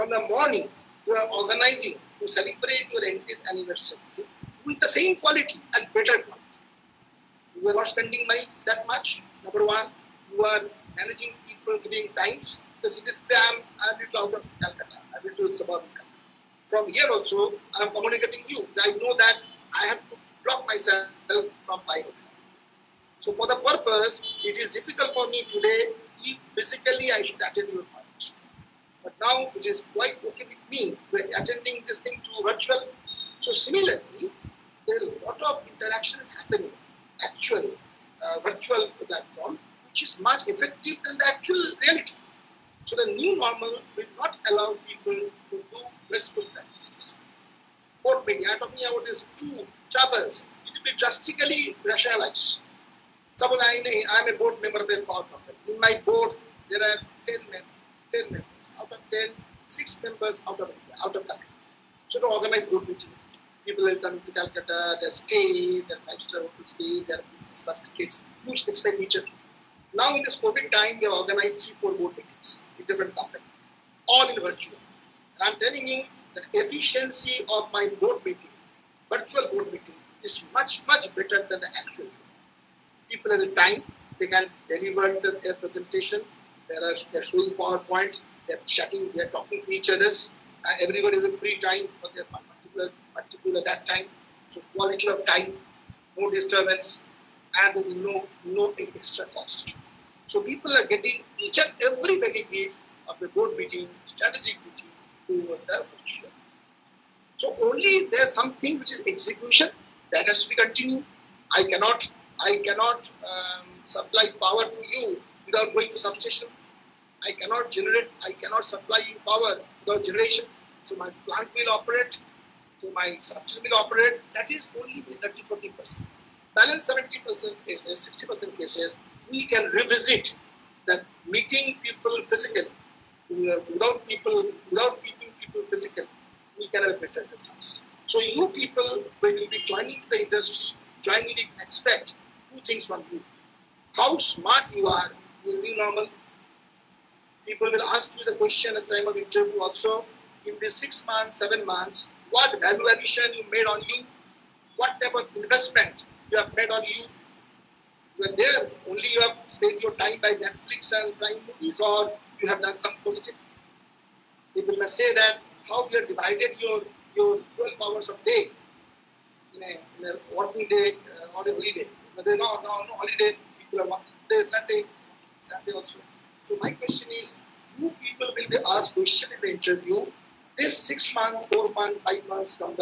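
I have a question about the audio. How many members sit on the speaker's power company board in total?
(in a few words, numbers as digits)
10.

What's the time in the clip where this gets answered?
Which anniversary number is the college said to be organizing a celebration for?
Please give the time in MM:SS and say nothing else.
00:03.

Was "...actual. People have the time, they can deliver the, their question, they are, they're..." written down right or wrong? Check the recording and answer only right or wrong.
wrong.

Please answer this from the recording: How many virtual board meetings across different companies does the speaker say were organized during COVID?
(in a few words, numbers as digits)
3 or 4.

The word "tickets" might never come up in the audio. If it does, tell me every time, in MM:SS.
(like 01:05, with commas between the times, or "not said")
01:07.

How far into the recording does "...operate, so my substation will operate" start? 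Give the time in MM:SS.
02:01.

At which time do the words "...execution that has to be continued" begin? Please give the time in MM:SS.
01:49.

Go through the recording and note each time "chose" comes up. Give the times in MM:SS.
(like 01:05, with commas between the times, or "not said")
not said.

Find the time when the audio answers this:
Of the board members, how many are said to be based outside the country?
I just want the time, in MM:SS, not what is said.
00:59.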